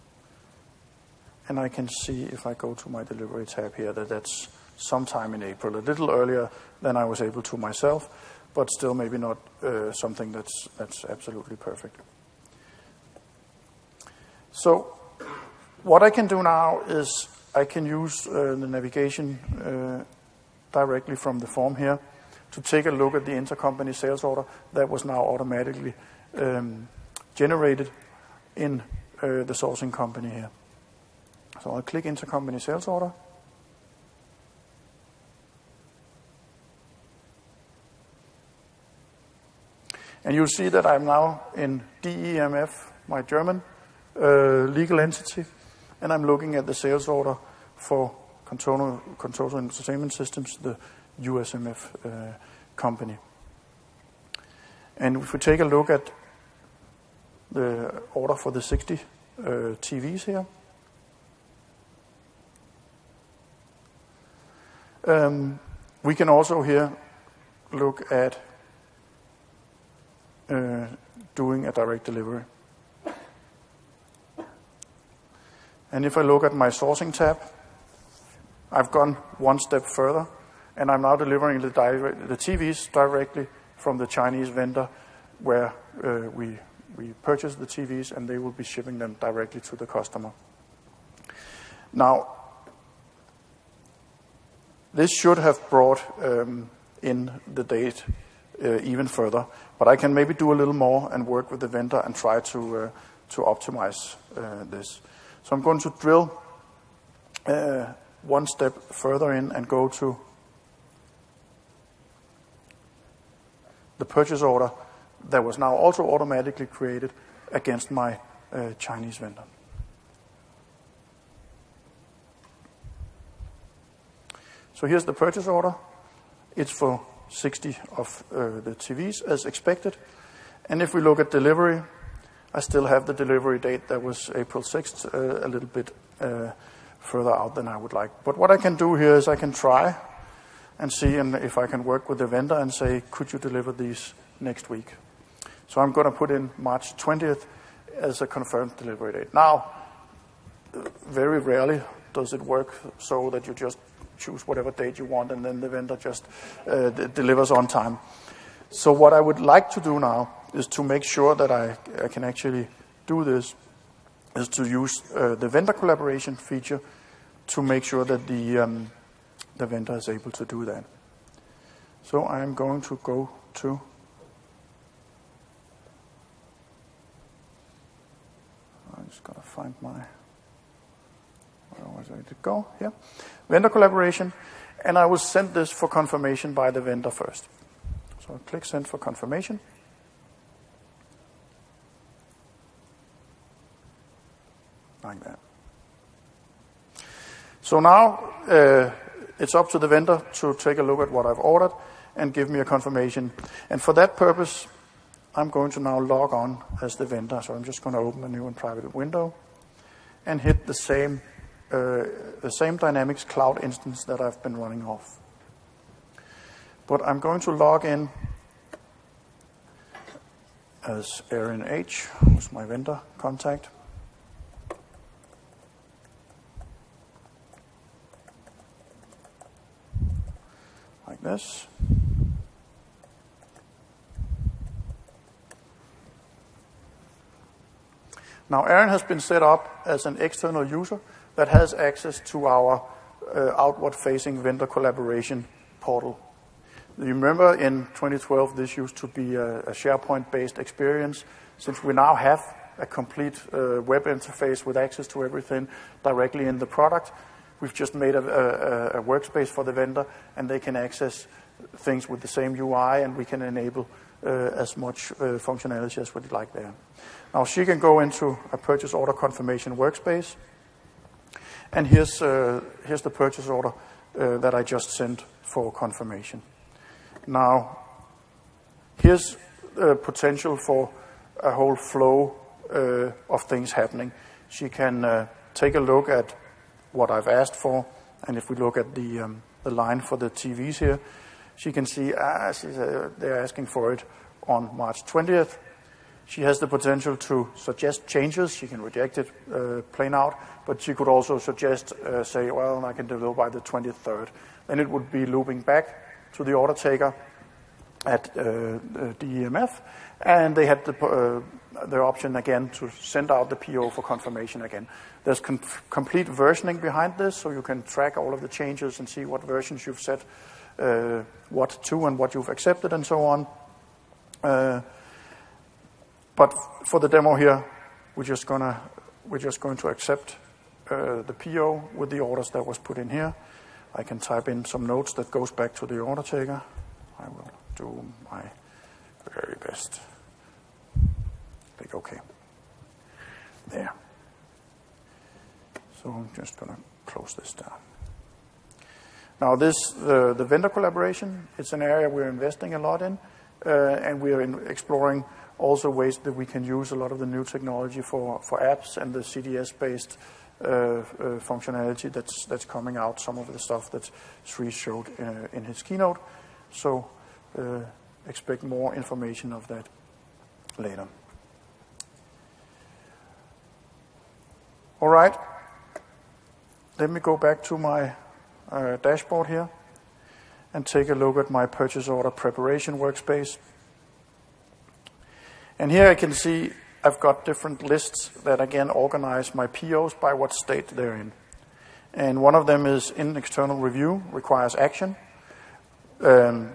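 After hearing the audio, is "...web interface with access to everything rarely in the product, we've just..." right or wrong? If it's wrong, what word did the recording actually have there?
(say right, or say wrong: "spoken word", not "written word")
wrong: "directly", not "rarely".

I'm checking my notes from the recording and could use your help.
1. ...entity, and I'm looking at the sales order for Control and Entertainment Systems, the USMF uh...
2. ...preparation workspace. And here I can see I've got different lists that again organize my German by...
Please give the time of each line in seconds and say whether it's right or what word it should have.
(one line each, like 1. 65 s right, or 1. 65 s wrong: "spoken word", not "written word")
1. 44 s right
2. 382 s wrong: "POs", not "German".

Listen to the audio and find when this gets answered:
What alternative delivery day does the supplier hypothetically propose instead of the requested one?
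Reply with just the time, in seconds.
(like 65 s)
303 s.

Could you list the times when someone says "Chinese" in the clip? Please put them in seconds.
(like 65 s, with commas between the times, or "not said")
84 s, 118 s.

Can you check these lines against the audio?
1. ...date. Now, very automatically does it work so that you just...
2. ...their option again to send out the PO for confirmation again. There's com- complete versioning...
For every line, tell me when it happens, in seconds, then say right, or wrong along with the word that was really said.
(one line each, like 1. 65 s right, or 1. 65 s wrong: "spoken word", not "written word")
1. 149 s wrong: "rarely", not "automatically"
2. 311 s right.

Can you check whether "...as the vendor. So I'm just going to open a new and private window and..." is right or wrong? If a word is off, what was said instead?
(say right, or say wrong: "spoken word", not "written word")
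right.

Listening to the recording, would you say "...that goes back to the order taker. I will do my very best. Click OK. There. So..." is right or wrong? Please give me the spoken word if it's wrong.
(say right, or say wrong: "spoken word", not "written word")
right.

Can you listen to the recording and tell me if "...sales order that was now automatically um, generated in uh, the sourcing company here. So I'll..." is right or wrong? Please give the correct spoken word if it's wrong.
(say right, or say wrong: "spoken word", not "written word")
right.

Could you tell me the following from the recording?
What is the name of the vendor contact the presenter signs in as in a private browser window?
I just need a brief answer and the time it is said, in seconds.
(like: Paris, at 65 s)
Aaron H, at 221 s.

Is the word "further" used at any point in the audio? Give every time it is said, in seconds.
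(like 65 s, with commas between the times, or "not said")
79 s, 99 s, 108 s, 136 s.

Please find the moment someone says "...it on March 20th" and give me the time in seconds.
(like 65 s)
293 s.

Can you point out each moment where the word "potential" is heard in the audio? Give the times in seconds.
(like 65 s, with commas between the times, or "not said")
279 s, 296 s.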